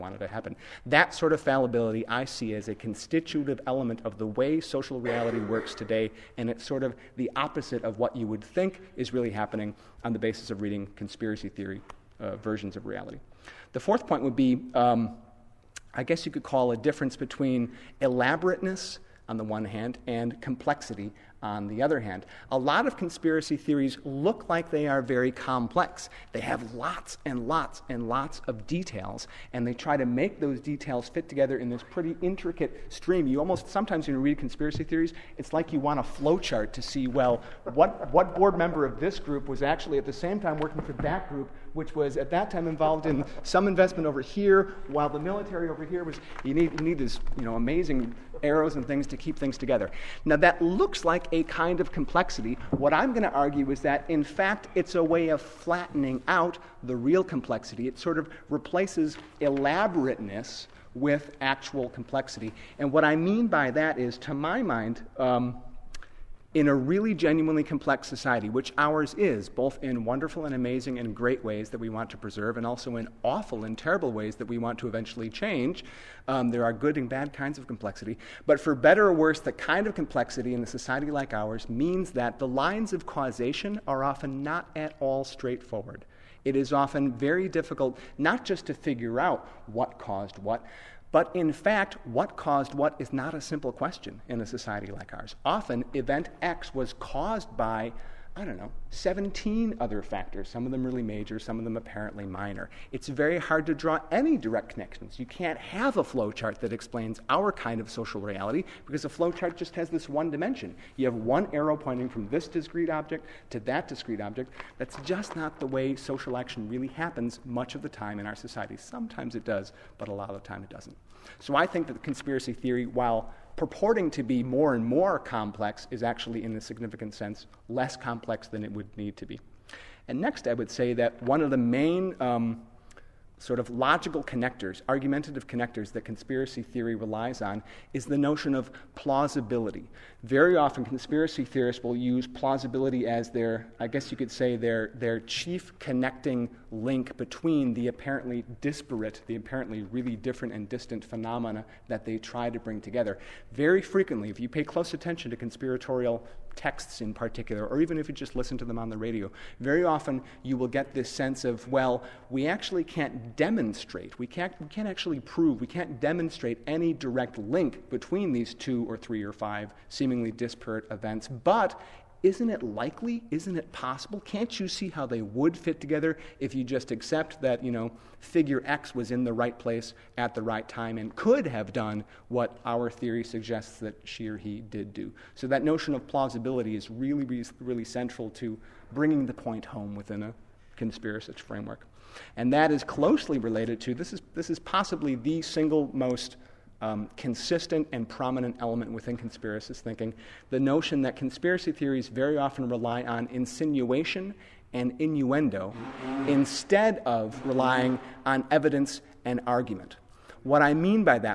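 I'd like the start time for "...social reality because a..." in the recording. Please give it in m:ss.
1:47.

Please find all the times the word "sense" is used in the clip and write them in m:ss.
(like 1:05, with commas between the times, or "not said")
2:07, 2:41.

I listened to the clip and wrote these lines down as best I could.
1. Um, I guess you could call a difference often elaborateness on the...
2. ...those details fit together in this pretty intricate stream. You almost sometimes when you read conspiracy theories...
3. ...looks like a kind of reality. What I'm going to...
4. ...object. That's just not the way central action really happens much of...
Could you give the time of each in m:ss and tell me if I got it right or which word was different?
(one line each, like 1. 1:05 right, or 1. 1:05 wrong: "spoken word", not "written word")
1. 0:14 wrong: "between", not "often"
2. 0:30 right
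3. 0:50 wrong: "complexity", not "reality"
4. 1:54 wrong: "social", not "central".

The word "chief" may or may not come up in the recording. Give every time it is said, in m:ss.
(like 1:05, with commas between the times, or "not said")
2:25.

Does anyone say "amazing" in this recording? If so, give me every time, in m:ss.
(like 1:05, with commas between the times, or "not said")
0:47, 1:10.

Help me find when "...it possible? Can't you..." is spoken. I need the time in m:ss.
2:53.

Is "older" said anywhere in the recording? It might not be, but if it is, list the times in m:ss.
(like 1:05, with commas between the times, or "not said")
not said.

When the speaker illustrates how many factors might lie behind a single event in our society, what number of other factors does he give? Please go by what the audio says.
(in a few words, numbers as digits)
17.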